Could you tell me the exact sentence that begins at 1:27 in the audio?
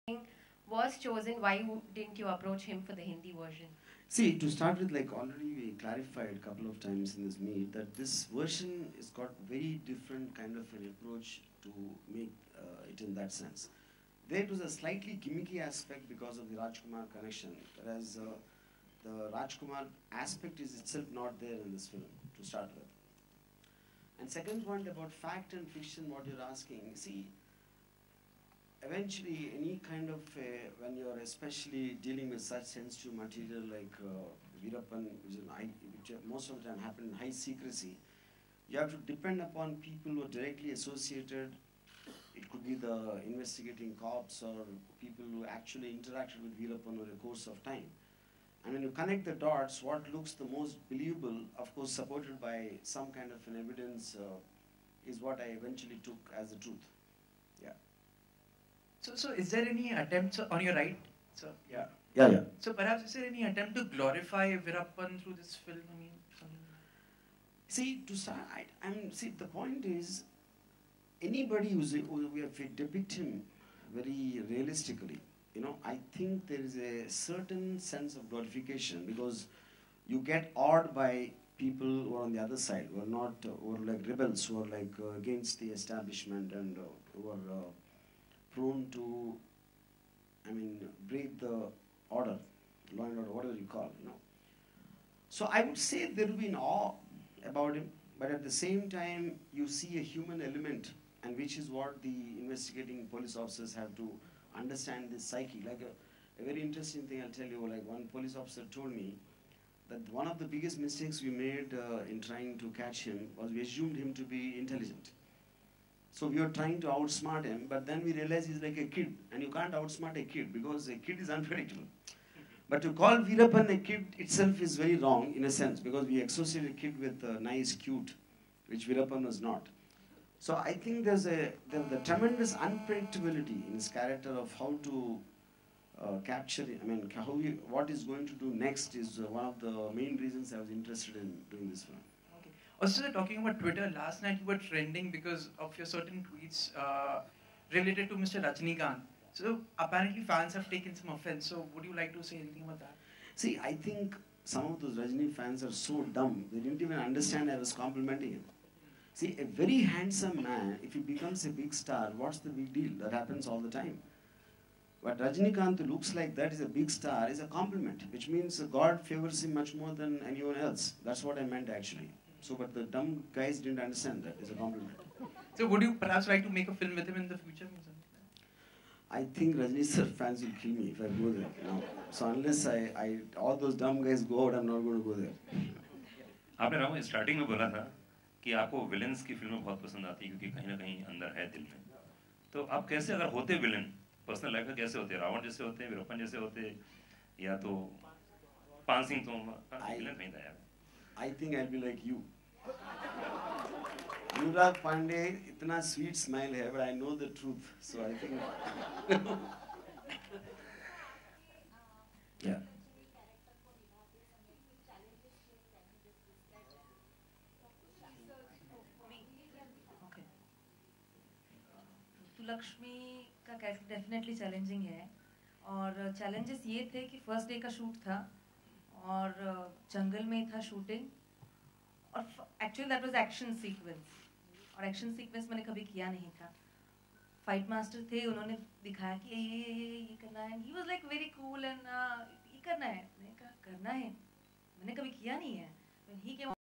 Uh, prone to, I mean, break the order, law and order, whatever you call, you know.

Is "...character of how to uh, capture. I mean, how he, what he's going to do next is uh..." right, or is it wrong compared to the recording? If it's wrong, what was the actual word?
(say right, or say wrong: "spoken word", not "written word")
right.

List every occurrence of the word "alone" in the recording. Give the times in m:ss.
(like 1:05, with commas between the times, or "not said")
not said.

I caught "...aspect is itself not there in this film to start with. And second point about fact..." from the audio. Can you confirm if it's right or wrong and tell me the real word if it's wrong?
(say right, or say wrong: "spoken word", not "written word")
right.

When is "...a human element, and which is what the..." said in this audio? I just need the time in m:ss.
1:39.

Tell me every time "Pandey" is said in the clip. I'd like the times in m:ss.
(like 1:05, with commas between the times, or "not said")
3:24.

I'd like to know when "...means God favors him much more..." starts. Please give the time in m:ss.
2:48.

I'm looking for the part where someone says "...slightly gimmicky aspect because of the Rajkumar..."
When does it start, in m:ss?
0:14.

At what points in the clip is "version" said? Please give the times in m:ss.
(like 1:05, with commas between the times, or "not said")
0:03, 0:08.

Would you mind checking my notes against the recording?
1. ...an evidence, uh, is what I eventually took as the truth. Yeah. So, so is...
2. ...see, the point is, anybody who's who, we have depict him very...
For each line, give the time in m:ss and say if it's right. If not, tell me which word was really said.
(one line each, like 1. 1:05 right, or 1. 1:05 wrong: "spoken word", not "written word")
1. 0:53 right
2. 1:09 right.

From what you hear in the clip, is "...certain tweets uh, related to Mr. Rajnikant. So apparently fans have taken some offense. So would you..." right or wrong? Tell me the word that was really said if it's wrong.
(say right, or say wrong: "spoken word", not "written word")
right.